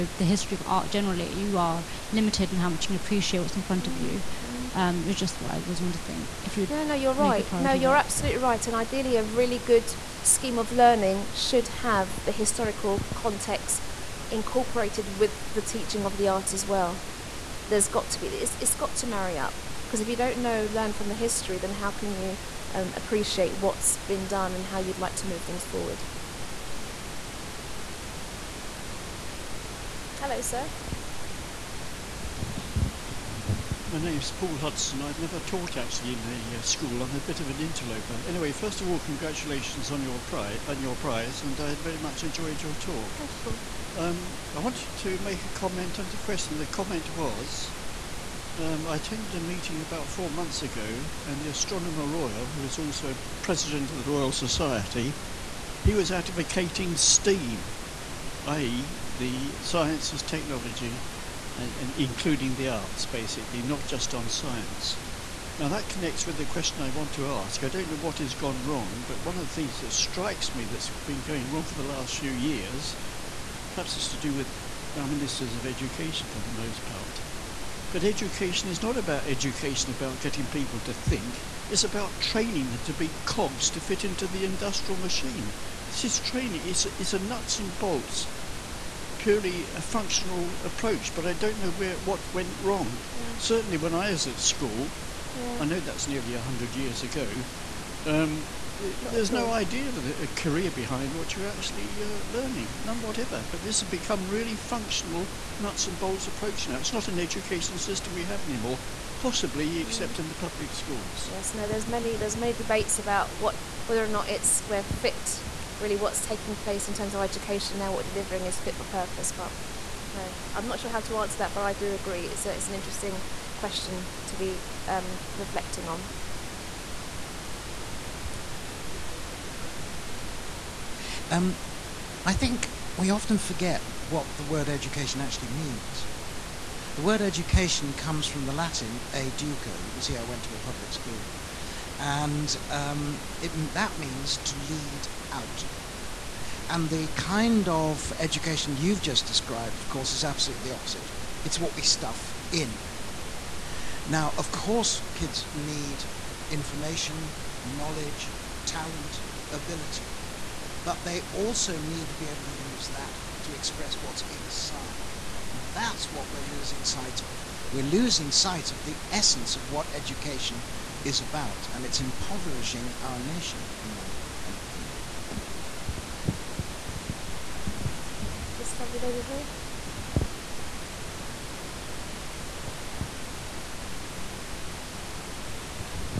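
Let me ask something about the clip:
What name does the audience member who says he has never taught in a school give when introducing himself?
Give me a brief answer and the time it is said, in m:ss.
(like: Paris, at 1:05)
Paul Hudson, at 0:34.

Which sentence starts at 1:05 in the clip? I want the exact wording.
Now, that connects with the question I want to ask.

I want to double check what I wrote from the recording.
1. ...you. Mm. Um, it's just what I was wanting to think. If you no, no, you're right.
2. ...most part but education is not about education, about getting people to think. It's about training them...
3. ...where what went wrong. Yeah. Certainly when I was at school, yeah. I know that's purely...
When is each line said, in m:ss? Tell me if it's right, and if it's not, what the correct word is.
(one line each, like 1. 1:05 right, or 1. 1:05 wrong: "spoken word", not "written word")
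1. 0:03 right
2. 1:16 right
3. 1:31 wrong: "nearly", not "purely".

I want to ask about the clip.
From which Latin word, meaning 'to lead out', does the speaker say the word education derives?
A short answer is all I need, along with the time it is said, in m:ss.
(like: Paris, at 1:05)
educo, at 2:19.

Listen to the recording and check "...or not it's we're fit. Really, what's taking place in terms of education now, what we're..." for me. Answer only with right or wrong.
right.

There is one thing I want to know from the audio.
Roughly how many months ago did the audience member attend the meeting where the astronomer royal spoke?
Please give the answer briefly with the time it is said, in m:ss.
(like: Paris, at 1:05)
4, at 0:50.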